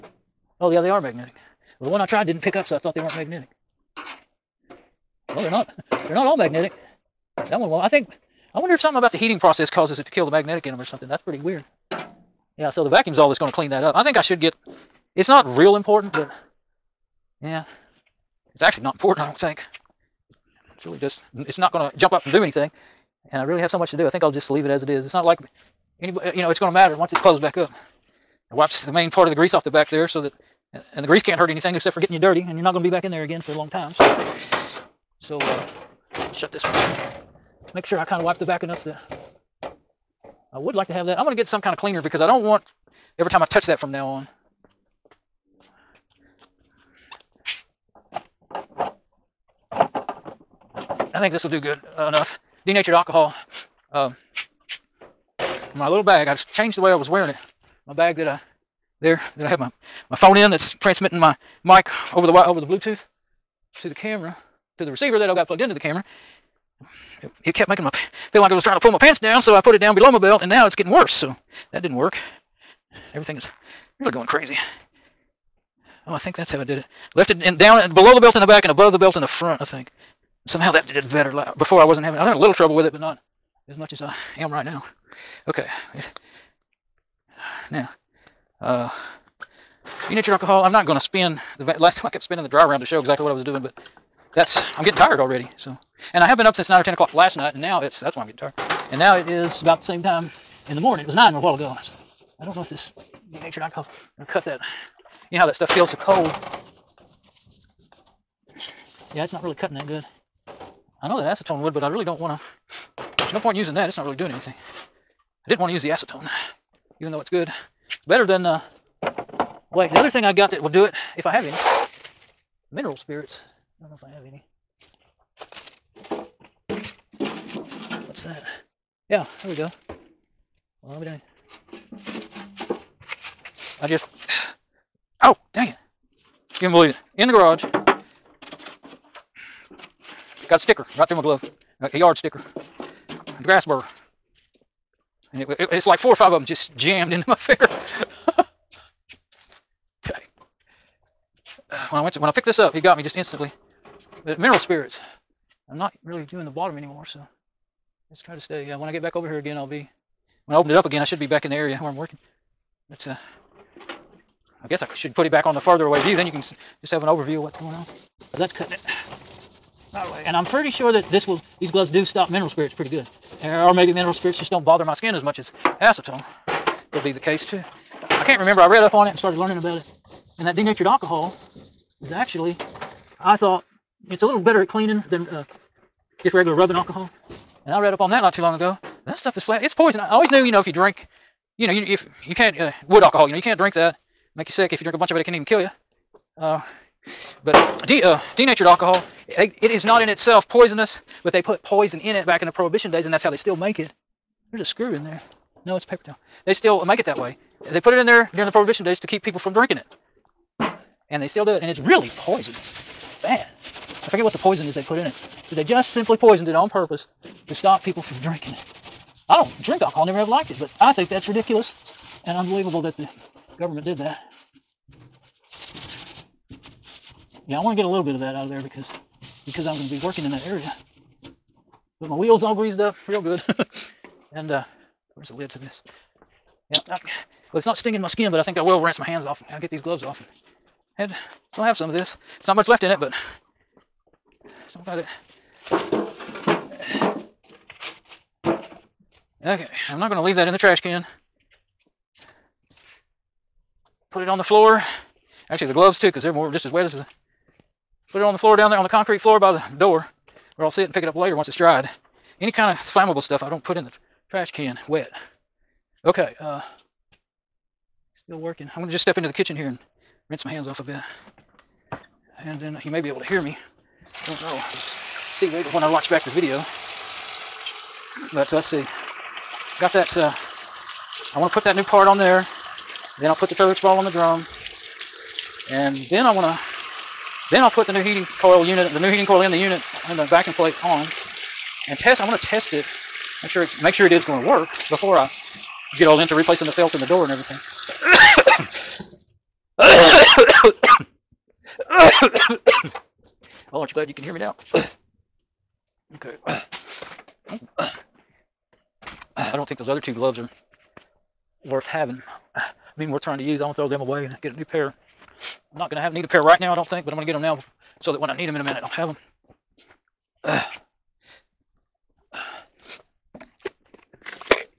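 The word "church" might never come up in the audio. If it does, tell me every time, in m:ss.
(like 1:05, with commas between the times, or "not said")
4:43.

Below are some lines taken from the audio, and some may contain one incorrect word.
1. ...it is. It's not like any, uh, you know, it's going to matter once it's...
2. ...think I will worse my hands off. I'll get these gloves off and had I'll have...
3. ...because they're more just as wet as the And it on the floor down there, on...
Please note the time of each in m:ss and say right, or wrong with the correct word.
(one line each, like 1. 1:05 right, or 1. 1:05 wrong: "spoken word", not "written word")
1. 0:24 right
2. 3:58 wrong: "rinse", not "worse"
3. 4:16 wrong: "Put", not "And".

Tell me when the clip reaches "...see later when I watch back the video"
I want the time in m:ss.
4:35.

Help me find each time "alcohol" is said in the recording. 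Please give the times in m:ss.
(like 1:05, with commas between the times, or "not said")
0:52, 1:30, 1:43, 3:00, 3:06, 3:13, 3:18, 3:39.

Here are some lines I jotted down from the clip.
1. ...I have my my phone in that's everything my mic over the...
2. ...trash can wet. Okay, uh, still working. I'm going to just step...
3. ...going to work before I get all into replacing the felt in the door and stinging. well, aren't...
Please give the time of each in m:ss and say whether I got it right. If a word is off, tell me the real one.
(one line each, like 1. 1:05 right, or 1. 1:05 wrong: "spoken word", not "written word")
1. 0:59 wrong: "transmitting", not "everything"
2. 4:24 right
3. 4:54 wrong: "everything", not "stinging".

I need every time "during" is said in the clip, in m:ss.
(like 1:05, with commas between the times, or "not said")
3:28.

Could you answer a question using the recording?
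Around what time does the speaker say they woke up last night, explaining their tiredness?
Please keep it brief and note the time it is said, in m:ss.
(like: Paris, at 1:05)
9 or 10, at 1:36.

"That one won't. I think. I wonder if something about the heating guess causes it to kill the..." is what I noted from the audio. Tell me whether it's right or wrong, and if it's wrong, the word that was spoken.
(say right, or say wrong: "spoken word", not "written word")
wrong: "process", not "guess".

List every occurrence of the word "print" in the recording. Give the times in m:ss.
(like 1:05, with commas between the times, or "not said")
not said.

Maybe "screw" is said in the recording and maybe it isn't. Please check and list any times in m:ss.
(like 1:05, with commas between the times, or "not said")
3:24.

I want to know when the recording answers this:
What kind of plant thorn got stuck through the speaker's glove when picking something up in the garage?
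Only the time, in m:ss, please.
2:23.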